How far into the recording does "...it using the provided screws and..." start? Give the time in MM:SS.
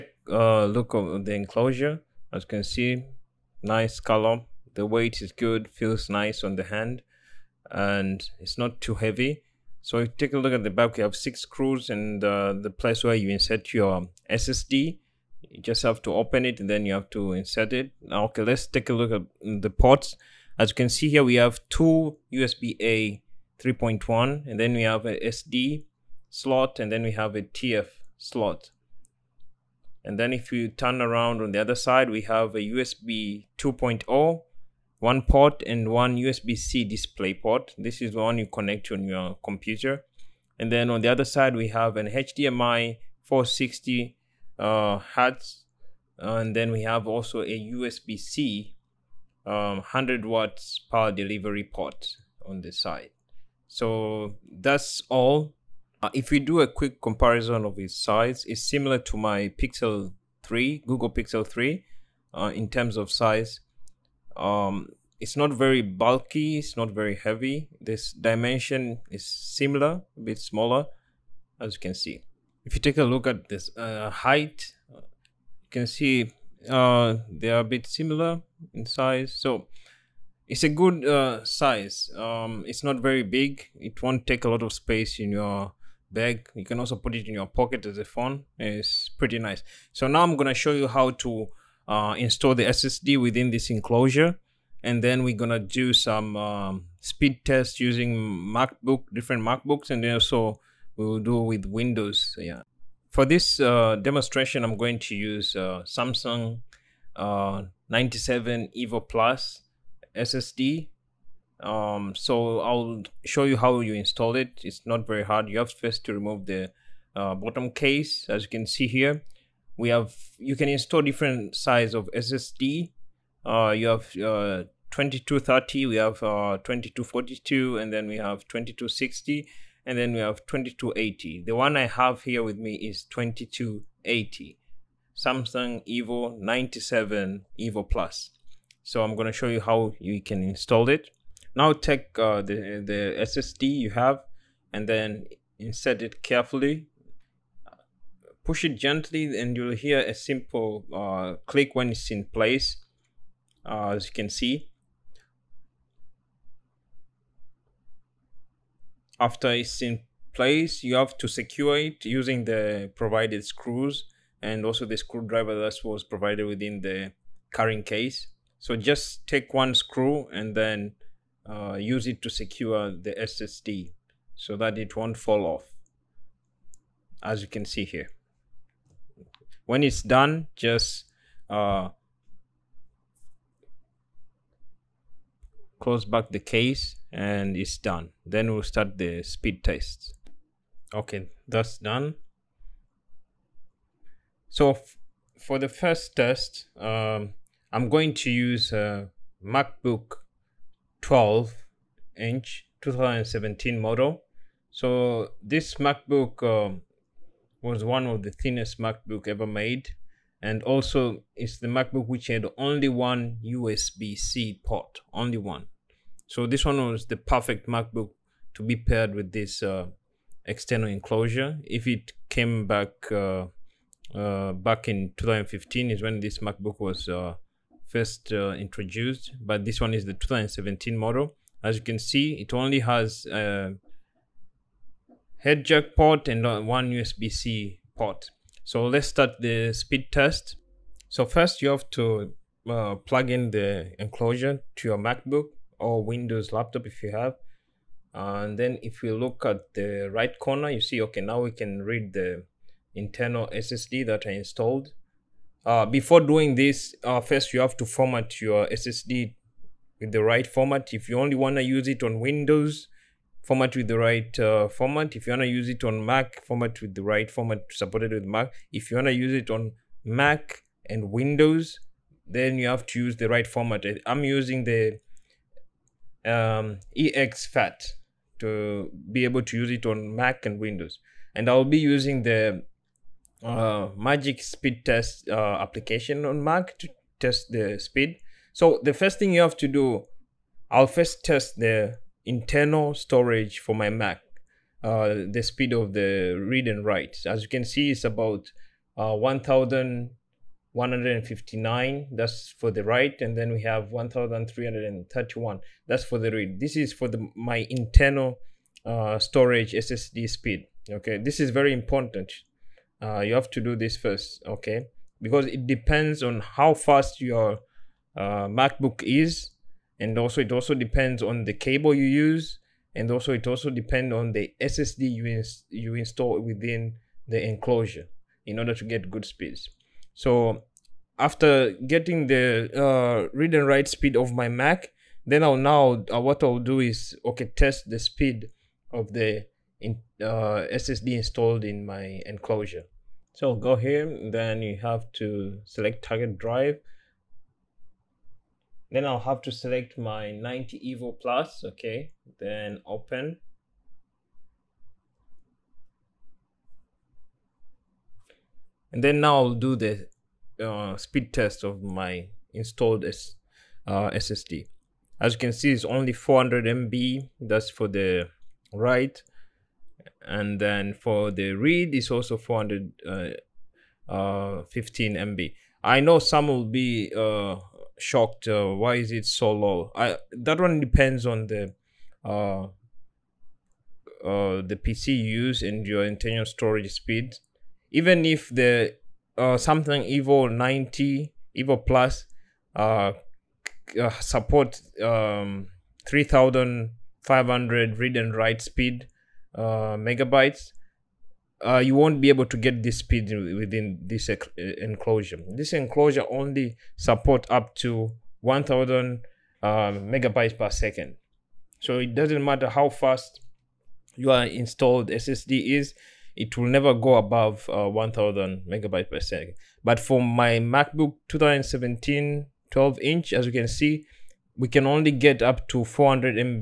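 02:41.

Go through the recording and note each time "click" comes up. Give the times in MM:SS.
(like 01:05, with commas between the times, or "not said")
02:31.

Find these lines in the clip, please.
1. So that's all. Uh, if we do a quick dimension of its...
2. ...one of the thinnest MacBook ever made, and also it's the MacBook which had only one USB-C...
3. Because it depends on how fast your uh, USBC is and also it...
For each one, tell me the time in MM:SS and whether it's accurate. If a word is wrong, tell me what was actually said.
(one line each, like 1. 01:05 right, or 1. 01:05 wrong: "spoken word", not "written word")
1. 00:53 wrong: "comparison", not "dimension"
2. 03:27 right
3. 05:15 wrong: "MacBook", not "USBC".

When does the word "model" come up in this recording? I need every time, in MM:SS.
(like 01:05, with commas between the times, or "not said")
03:23, 03:50.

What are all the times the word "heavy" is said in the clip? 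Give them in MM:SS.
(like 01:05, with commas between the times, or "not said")
00:08, 01:07.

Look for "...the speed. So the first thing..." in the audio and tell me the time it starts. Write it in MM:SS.
04:47.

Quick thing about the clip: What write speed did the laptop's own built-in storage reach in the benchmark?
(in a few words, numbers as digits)
1,159.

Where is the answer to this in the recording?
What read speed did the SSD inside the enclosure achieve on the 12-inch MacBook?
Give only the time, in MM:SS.
06:12.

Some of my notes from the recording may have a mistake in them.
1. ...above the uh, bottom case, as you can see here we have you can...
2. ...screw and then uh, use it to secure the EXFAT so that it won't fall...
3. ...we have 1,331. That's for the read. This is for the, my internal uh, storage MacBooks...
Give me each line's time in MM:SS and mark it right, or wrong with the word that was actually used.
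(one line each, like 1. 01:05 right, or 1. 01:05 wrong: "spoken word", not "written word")
1. 01:56 wrong: "remove", not "above"
2. 02:49 wrong: "SSD", not "EXFAT"
3. 05:03 wrong: "SSD", not "MacBooks".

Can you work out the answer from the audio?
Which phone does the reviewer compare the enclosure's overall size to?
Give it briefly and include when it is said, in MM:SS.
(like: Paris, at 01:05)
Google Pixel 3, at 01:00.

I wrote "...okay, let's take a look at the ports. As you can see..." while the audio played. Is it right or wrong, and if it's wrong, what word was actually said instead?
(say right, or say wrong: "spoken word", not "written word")
right.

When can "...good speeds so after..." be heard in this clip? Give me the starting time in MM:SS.
05:29.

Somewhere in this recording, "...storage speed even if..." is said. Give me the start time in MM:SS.
06:26.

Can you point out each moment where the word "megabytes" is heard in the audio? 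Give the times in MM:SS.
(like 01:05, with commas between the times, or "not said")
06:40, 06:50, 06:58.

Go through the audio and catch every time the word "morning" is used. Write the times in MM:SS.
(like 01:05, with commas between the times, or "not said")
not said.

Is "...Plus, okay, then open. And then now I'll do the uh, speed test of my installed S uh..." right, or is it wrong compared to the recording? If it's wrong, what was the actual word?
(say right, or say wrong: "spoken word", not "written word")
right.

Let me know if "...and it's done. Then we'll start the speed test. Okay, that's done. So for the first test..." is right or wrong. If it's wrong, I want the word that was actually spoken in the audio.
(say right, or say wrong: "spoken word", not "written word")
right.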